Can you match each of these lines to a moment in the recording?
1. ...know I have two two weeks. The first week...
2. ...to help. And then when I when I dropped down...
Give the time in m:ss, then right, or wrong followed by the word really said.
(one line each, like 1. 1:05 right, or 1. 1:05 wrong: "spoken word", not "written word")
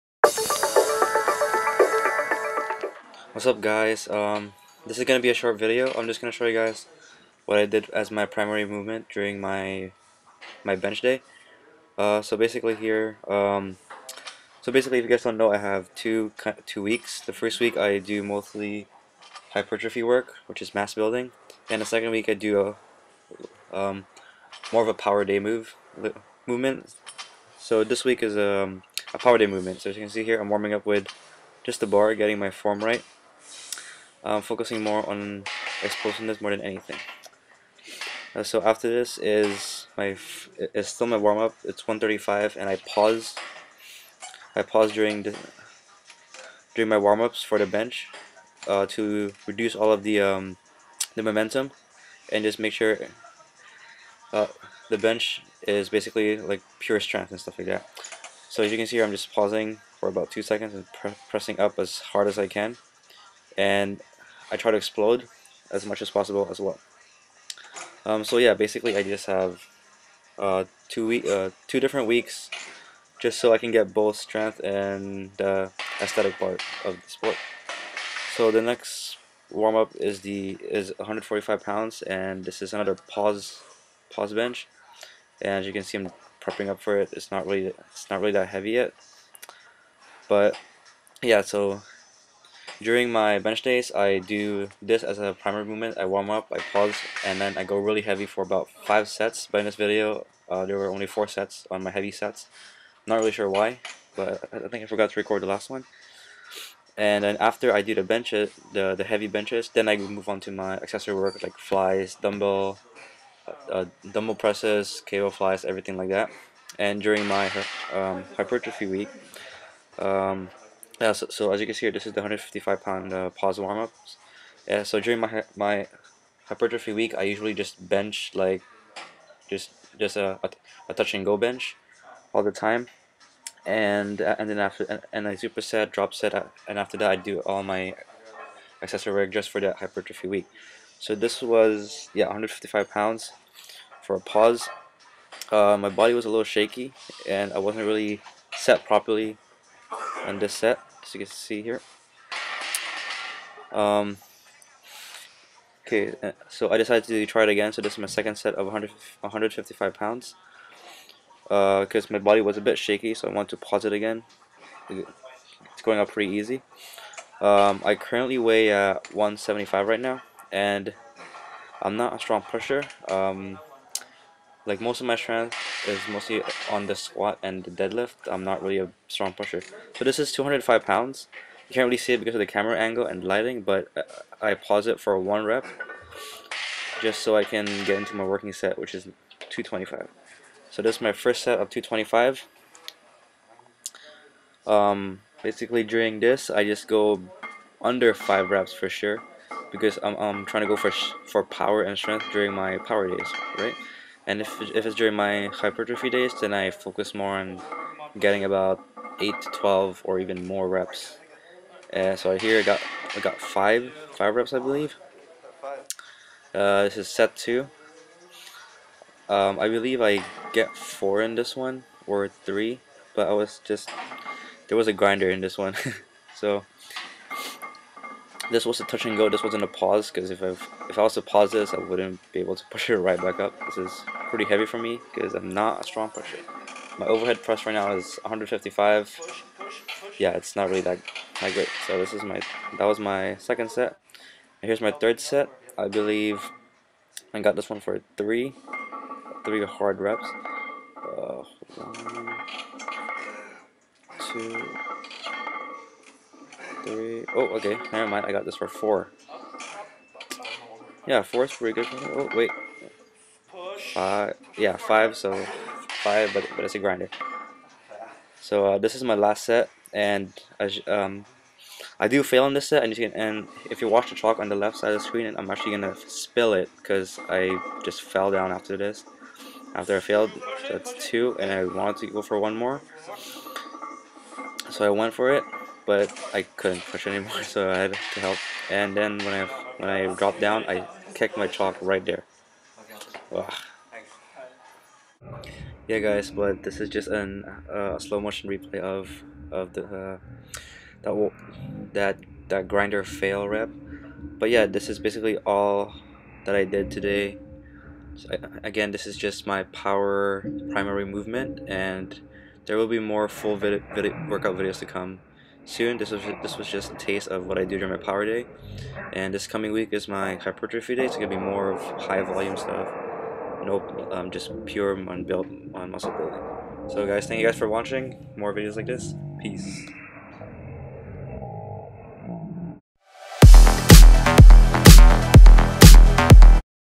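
1. 0:15 right
2. 4:48 right.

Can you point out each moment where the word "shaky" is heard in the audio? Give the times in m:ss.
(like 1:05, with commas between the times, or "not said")
2:26, 2:42.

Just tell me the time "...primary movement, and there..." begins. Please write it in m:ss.
5:10.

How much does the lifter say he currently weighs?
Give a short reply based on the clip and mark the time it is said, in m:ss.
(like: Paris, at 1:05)
175, at 2:47.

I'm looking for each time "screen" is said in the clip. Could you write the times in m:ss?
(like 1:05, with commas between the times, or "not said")
4:35.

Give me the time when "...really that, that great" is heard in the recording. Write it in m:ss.
4:00.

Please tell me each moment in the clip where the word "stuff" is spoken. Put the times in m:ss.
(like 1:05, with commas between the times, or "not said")
0:57, 5:22.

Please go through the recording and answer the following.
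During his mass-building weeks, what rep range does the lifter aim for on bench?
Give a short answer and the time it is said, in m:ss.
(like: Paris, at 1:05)
8 to 12, at 3:29.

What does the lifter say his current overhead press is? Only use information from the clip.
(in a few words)
155.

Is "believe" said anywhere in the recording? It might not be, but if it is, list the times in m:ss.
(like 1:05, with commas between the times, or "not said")
3:34, 3:39, 4:05.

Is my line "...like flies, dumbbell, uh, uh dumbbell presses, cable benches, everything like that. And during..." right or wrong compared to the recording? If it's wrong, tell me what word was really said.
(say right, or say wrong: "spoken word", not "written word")
wrong: "flies", not "benches".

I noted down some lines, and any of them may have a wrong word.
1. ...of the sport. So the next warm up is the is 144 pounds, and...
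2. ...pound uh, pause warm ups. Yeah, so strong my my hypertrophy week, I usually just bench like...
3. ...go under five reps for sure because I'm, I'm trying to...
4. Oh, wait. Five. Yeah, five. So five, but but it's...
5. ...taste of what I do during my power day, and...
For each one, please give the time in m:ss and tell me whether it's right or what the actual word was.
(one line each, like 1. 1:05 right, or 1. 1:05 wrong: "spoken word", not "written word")
1. 1:16 wrong: "145", not "144"
2. 2:02 wrong: "during", not "strong"
3. 3:16 right
4. 4:21 right
5. 5:16 right.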